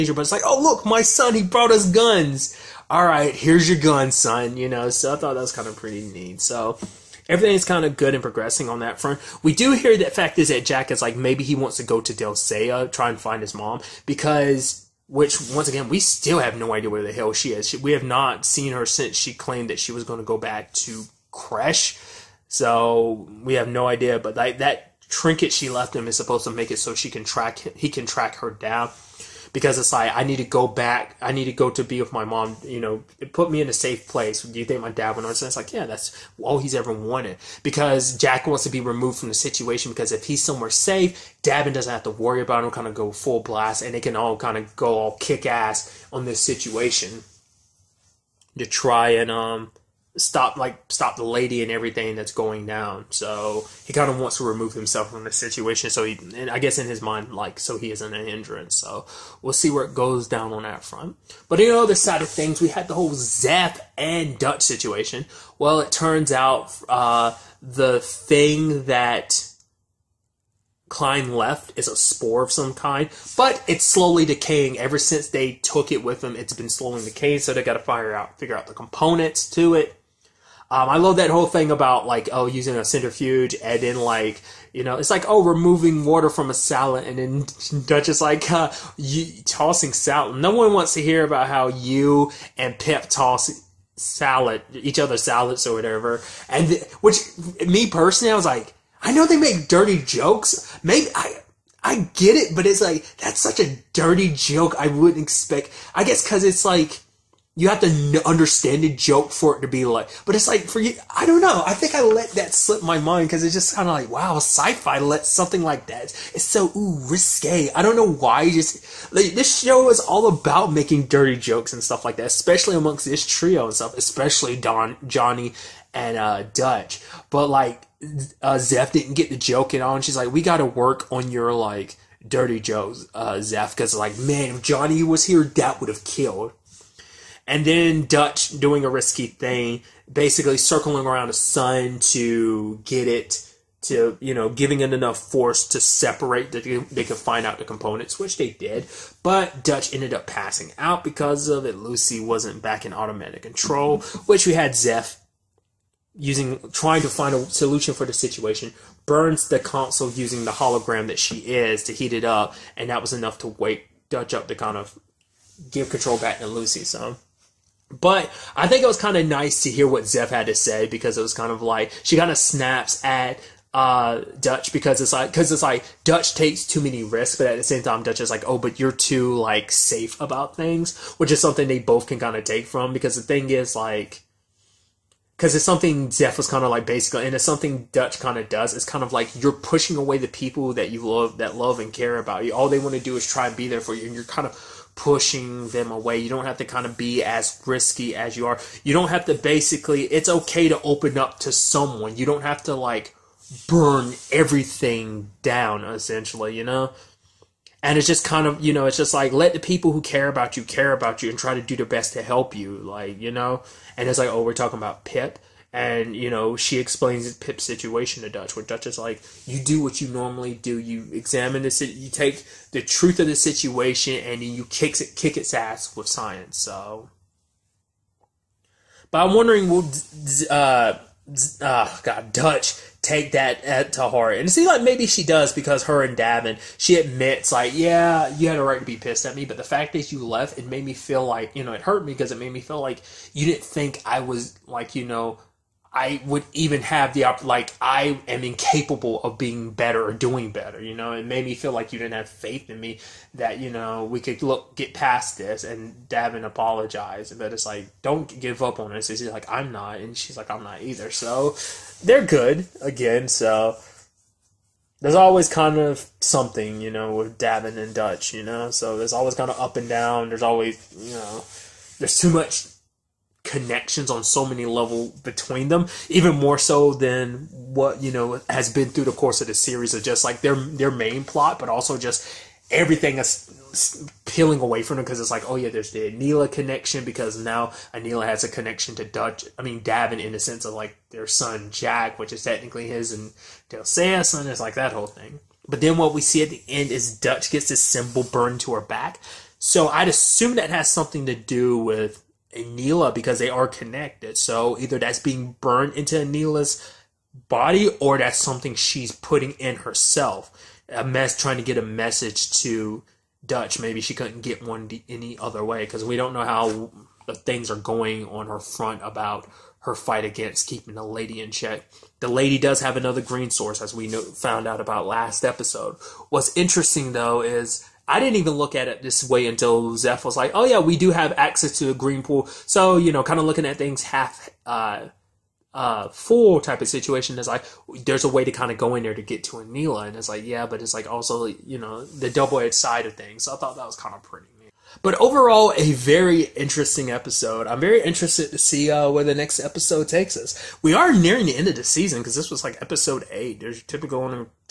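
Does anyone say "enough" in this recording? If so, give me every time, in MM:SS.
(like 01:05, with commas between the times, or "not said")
02:24, 02:43.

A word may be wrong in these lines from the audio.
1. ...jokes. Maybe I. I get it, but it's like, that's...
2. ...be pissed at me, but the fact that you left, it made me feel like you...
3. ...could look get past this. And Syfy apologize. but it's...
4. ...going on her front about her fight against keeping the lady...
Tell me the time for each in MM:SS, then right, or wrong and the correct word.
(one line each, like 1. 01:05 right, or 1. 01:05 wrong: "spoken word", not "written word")
1. 01:40 right
2. 03:58 right
3. 04:14 wrong: "Davin", not "Syfy"
4. 05:17 right.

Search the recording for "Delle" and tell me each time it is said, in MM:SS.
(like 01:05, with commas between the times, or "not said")
00:12, 04:53.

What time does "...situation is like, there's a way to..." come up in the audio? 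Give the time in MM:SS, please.
05:36.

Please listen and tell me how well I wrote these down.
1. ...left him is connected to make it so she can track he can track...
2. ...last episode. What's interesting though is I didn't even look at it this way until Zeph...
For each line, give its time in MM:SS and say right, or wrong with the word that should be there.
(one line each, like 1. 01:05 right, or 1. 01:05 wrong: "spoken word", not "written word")
1. 00:25 wrong: "supposed", not "connected"
2. 05:25 right.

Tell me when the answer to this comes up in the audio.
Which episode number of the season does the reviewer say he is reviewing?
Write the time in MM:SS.
05:53.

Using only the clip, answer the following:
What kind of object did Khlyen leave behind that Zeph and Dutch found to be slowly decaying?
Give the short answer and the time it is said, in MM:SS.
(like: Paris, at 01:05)
A spore, at 01:11.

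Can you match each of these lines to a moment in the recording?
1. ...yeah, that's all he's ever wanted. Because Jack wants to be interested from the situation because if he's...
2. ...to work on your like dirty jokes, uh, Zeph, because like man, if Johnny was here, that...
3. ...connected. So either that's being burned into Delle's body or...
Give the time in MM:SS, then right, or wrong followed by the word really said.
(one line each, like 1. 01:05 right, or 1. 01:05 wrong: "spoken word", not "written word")
1. 00:35 wrong: "removed", not "interested"
2. 02:10 right
3. 05:03 wrong: "Aneela", not "Delle".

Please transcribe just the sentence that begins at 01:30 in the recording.
No one wants to hear about how you and Pep toss salad each other's salads or whatever.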